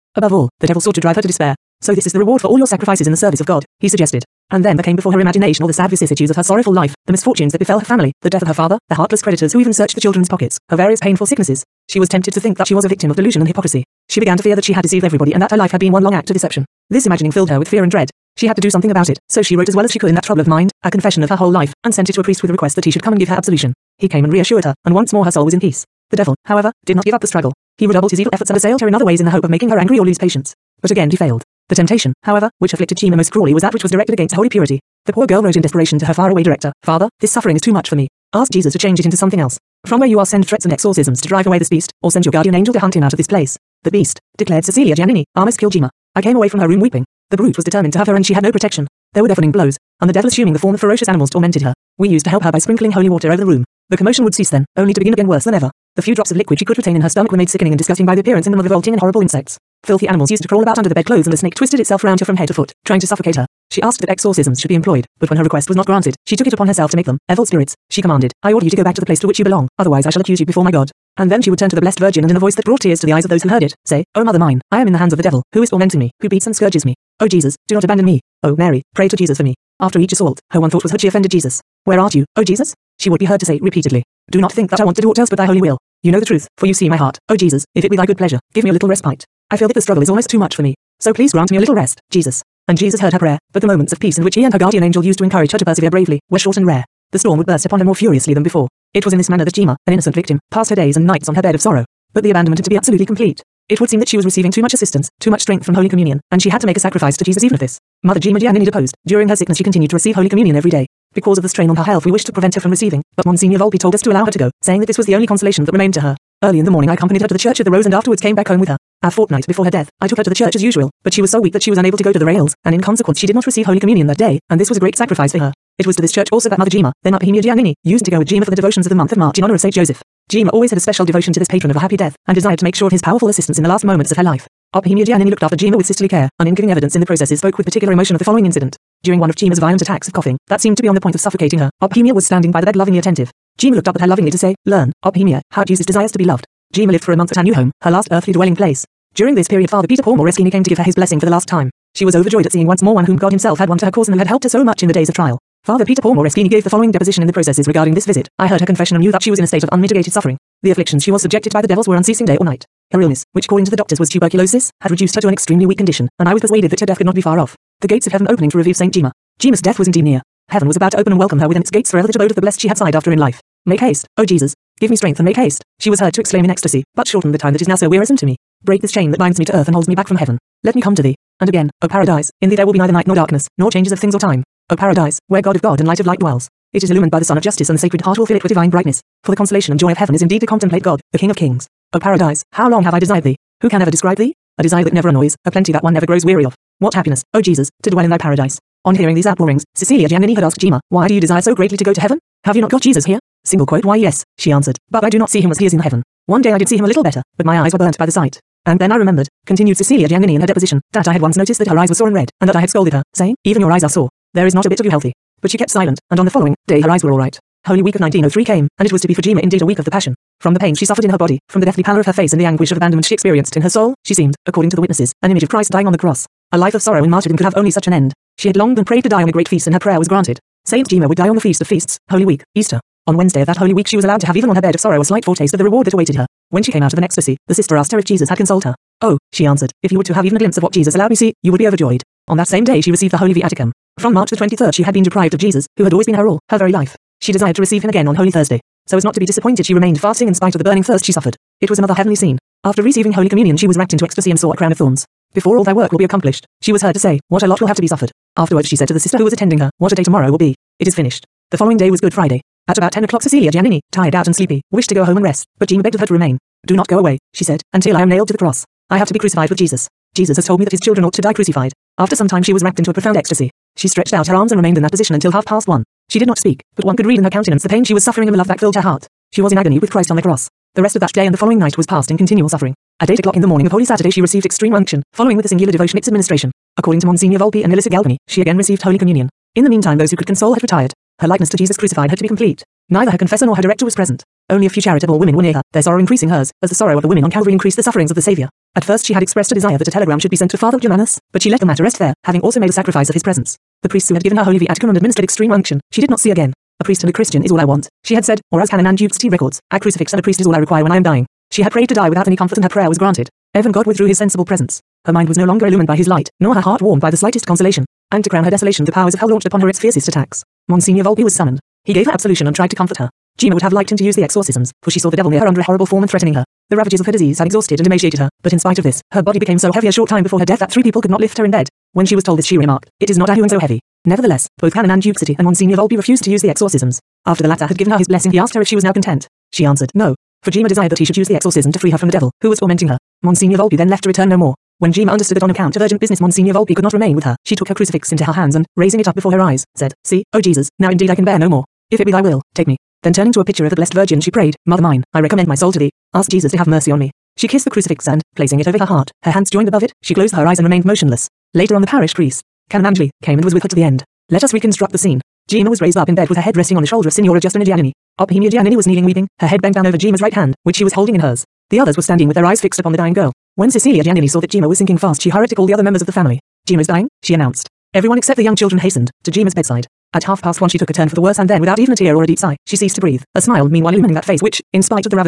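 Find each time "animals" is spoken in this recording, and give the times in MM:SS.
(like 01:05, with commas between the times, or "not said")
00:51, 01:00.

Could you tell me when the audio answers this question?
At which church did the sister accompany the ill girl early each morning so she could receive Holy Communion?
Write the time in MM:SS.
01:57.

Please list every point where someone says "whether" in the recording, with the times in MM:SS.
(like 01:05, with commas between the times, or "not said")
not said.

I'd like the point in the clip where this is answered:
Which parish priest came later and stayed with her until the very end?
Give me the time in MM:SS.
06:02.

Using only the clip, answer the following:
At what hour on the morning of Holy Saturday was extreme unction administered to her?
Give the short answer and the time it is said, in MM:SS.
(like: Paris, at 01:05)
8 o'clock, at 04:43.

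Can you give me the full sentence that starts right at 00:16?
This imagining filled her with fear and dread.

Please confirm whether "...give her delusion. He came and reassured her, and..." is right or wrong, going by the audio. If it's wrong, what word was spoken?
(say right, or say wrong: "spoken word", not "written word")
wrong: "absolution", not "delusion".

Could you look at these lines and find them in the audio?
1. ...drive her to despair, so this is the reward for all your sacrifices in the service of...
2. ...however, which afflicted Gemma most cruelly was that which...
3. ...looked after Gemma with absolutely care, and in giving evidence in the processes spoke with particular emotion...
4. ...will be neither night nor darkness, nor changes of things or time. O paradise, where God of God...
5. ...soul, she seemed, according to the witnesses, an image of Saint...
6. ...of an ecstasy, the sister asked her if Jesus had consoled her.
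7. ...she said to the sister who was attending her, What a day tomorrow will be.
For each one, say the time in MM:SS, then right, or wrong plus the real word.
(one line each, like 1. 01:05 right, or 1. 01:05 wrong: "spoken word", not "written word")
1. 00:00 right
2. 00:32 right
3. 02:15 wrong: "sisterly", not "absolutely"
4. 03:02 right
5. 03:43 wrong: "Christ", not "Saint"
6. 03:56 right
7. 04:18 right.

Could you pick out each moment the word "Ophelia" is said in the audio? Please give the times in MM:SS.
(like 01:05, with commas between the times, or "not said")
02:25.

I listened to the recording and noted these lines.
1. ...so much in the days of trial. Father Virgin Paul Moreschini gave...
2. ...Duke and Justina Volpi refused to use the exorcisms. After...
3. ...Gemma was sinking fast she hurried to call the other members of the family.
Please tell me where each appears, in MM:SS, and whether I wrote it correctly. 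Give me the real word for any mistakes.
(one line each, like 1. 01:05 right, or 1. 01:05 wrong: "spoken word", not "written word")
1. 02:34 wrong: "Peter", not "Virgin"
2. 05:35 wrong: "Monsignor", not "Justina"
3. 06:14 right.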